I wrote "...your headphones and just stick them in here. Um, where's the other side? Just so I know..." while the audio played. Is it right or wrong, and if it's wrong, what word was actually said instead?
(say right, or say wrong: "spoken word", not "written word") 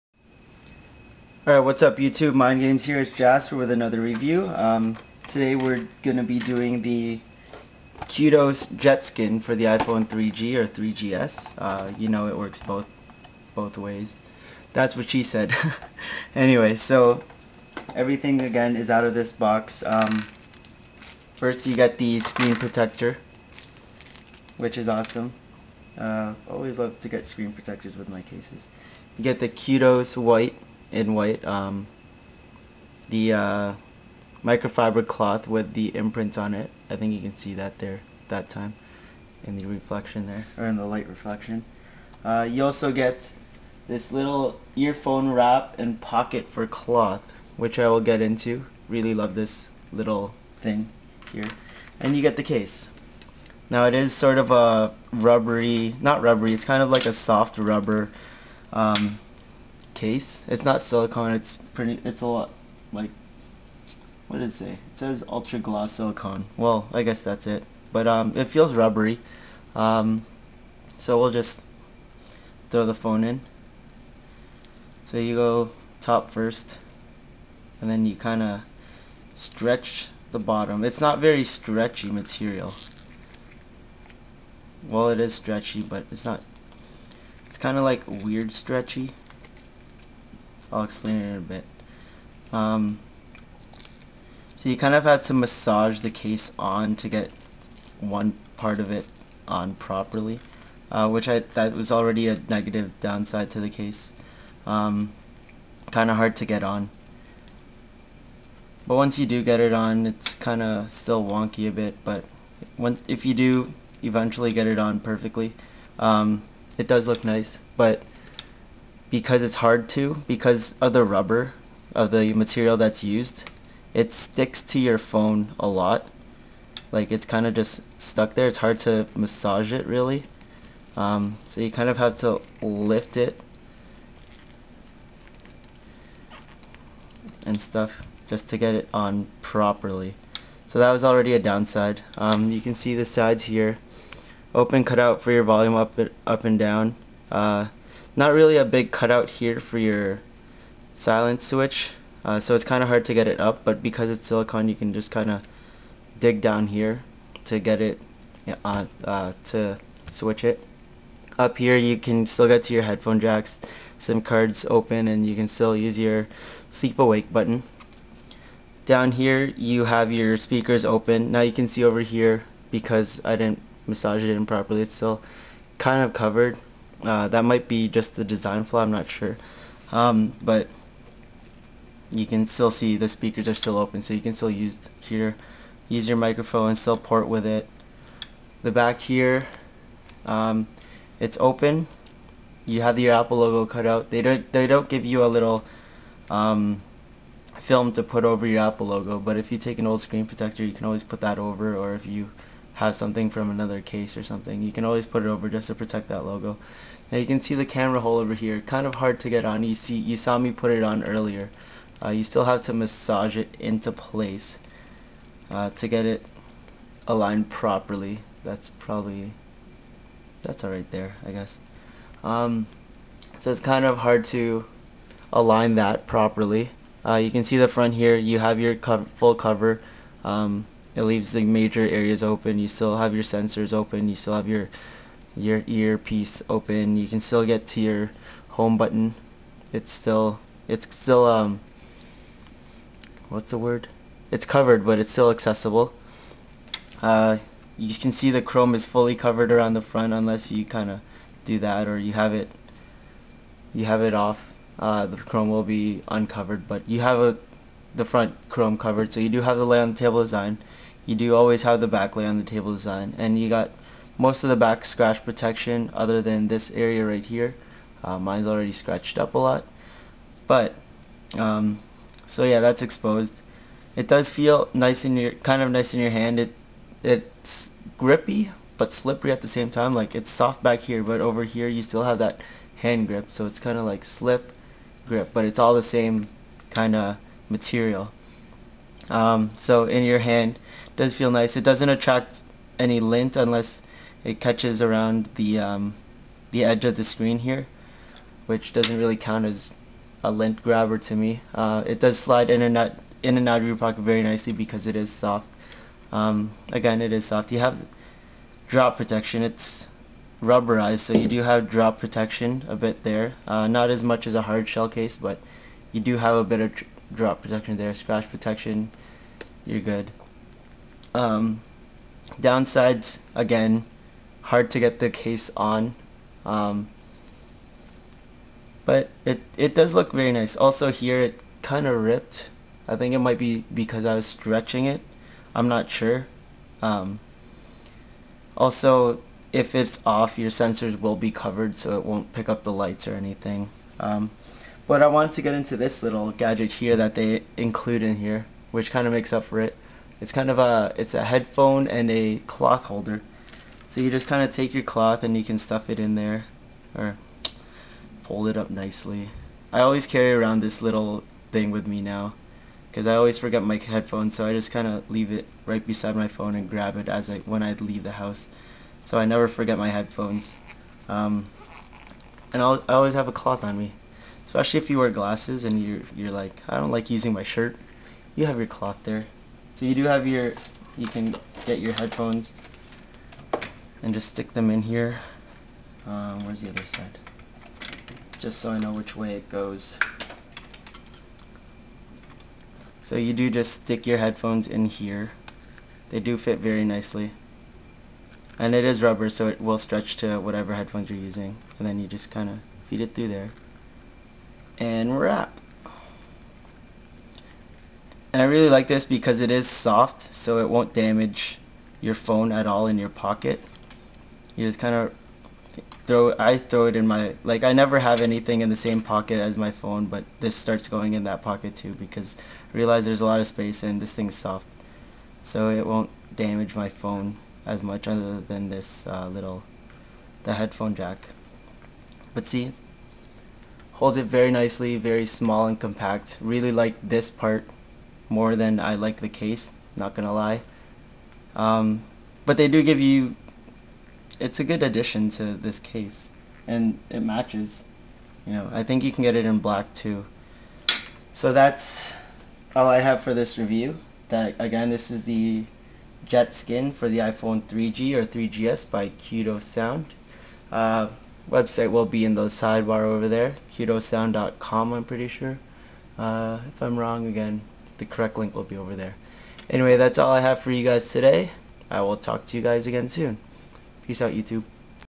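right.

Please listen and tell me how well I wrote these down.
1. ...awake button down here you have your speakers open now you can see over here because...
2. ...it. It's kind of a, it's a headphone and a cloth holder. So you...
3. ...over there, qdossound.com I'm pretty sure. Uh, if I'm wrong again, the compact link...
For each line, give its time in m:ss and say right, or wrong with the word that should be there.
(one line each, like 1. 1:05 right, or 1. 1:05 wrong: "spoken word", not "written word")
1. 2:46 right
2. 5:49 right
3. 7:43 wrong: "correct", not "compact".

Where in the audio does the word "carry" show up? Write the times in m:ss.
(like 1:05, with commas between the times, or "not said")
6:00.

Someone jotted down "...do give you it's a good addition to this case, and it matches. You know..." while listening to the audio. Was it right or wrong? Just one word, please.
right.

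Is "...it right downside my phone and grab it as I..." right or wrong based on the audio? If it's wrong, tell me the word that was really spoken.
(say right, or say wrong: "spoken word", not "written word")
wrong: "beside", not "downside".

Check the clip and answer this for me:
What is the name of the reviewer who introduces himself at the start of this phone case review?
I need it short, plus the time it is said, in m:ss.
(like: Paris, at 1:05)
Jasper, at 0:03.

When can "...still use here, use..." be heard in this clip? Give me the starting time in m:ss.
3:04.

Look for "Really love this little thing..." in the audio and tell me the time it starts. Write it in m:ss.
0:48.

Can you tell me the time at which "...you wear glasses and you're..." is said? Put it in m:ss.
6:14.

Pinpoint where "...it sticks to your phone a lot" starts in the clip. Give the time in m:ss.
2:03.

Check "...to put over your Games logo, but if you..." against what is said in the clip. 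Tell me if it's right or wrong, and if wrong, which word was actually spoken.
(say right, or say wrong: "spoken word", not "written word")
wrong: "Apple", not "Games".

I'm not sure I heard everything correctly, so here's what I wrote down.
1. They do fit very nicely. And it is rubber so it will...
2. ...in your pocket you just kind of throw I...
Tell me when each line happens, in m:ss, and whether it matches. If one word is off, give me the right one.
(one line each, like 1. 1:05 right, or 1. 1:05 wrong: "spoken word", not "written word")
1. 6:36 right
2. 6:52 right.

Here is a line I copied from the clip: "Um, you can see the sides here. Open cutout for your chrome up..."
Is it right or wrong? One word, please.
wrong.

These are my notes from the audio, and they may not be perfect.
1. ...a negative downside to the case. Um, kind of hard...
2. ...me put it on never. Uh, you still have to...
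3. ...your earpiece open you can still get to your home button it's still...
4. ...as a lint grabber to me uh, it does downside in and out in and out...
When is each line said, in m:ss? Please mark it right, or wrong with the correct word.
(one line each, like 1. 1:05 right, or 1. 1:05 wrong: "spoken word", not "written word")
1. 1:42 right
2. 3:30 wrong: "earlier", not "never"
3. 3:55 right
4. 4:59 wrong: "slide", not "downside".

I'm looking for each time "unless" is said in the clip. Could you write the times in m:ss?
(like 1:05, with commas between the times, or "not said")
4:10, 4:53.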